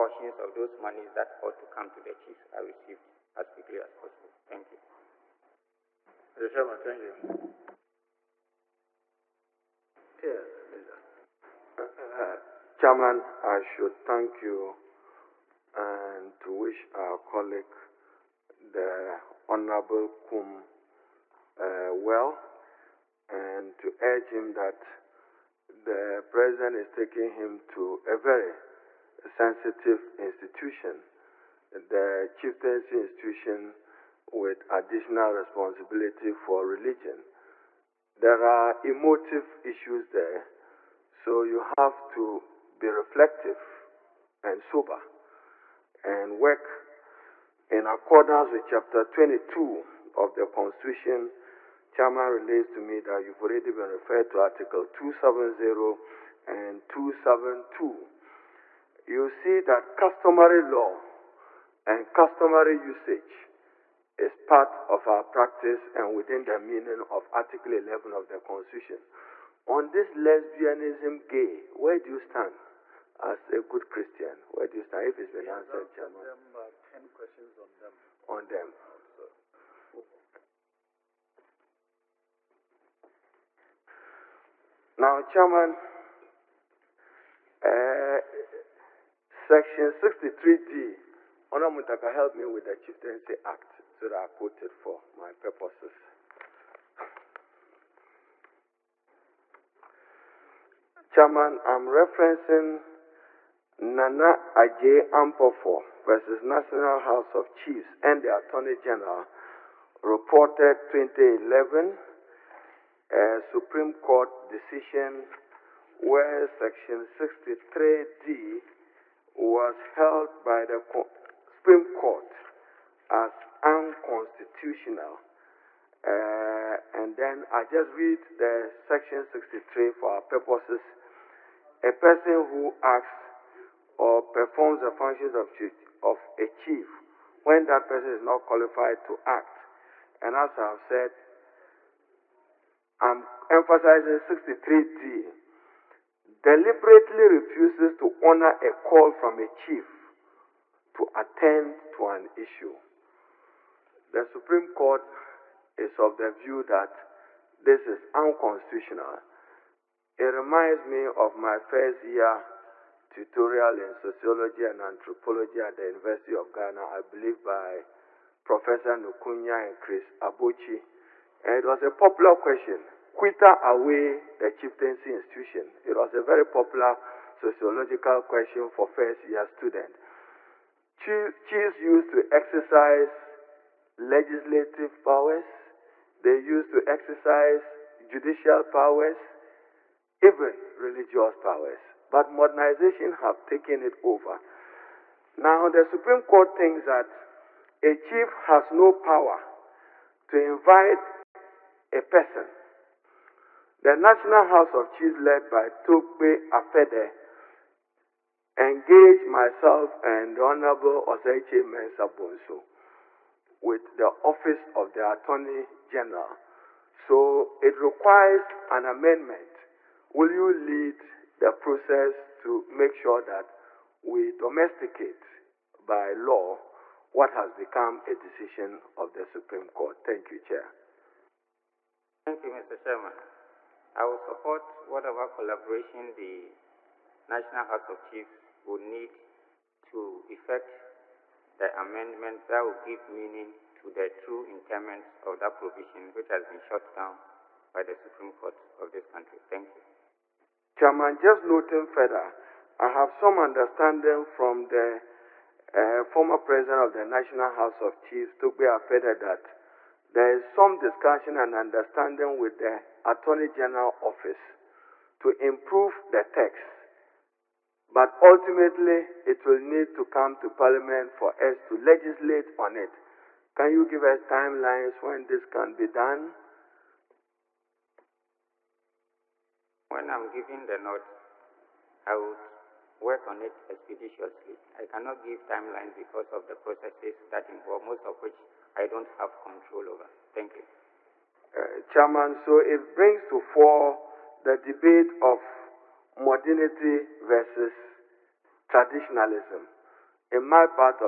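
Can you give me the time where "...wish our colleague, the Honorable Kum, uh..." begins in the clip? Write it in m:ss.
0:16.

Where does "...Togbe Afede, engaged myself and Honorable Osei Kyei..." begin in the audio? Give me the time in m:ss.
3:25.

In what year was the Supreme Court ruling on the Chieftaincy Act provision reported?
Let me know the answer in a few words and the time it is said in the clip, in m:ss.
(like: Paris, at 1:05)
2011, at 1:50.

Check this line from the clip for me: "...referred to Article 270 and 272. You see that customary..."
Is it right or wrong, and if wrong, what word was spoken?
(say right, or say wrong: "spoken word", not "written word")
right.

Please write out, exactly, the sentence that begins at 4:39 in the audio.
When I'm giving the note, I would work on it expeditiously.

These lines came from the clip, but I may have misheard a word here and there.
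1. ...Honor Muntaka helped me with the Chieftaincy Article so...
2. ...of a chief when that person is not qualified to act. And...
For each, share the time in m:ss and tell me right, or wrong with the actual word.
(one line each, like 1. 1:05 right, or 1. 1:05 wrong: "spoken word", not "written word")
1. 1:31 wrong: "Act", not "Article"
2. 2:16 right.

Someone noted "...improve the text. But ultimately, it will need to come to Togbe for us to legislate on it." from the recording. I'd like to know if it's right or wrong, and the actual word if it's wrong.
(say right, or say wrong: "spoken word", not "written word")
wrong: "Parliament", not "Togbe".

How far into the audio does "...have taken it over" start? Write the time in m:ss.
3:13.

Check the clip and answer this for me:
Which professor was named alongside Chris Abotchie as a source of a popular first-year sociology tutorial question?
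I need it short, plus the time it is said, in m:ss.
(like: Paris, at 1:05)
Professor Nukunya, at 2:48.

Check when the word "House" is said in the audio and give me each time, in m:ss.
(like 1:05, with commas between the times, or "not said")
1:46, 3:24, 3:57, 4:17.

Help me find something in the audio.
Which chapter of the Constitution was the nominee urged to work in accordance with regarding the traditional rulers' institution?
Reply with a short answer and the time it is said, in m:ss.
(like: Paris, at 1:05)
Chapter 22, at 0:48.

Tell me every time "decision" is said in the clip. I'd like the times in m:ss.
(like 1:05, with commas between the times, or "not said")
1:54, 3:48.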